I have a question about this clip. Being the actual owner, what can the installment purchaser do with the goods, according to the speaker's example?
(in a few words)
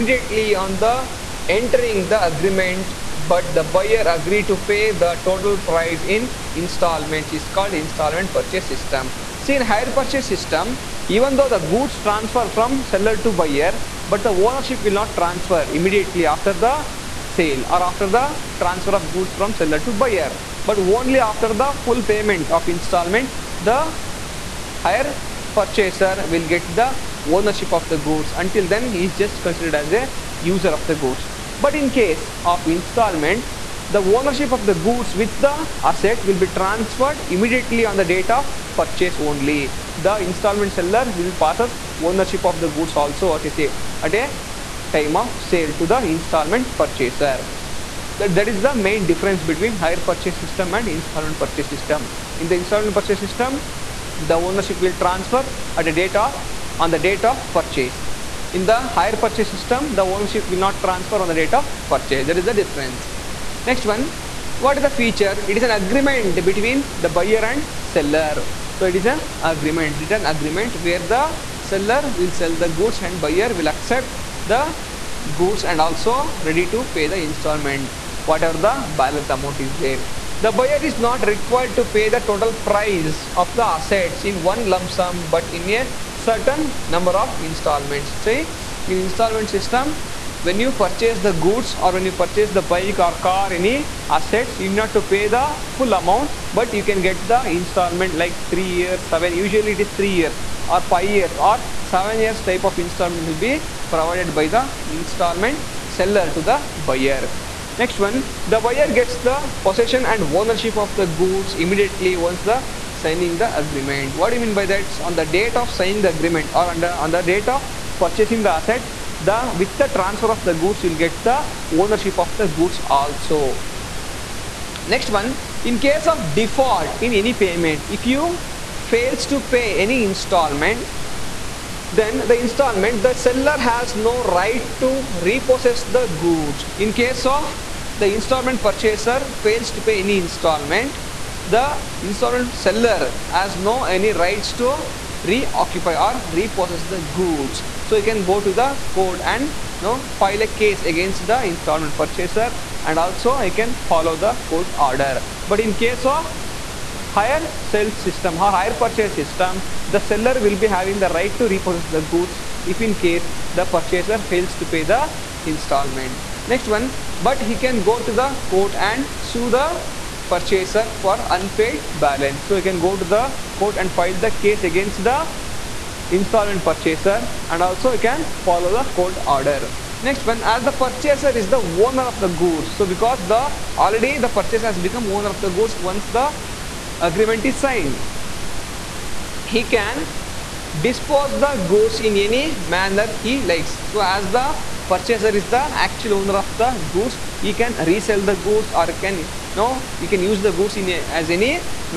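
resell the goods.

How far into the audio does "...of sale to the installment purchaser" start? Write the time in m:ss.
0:45.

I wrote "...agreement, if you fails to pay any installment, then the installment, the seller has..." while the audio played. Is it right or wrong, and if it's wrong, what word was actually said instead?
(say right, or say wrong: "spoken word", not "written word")
wrong: "payment", not "agreement".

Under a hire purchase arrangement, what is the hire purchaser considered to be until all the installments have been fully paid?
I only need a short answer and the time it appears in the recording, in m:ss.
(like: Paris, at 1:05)
a user, at 0:30.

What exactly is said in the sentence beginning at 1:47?
Next one, the buyer gets the possession and ownership of the goods immediately once the signing the agreement.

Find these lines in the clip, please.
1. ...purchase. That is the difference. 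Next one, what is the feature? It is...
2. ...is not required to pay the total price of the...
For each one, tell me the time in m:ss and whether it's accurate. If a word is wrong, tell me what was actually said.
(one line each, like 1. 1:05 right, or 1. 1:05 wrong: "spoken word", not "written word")
1. 1:01 right
2. 1:20 right.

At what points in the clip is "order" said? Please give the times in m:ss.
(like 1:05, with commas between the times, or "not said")
2:34, 2:59.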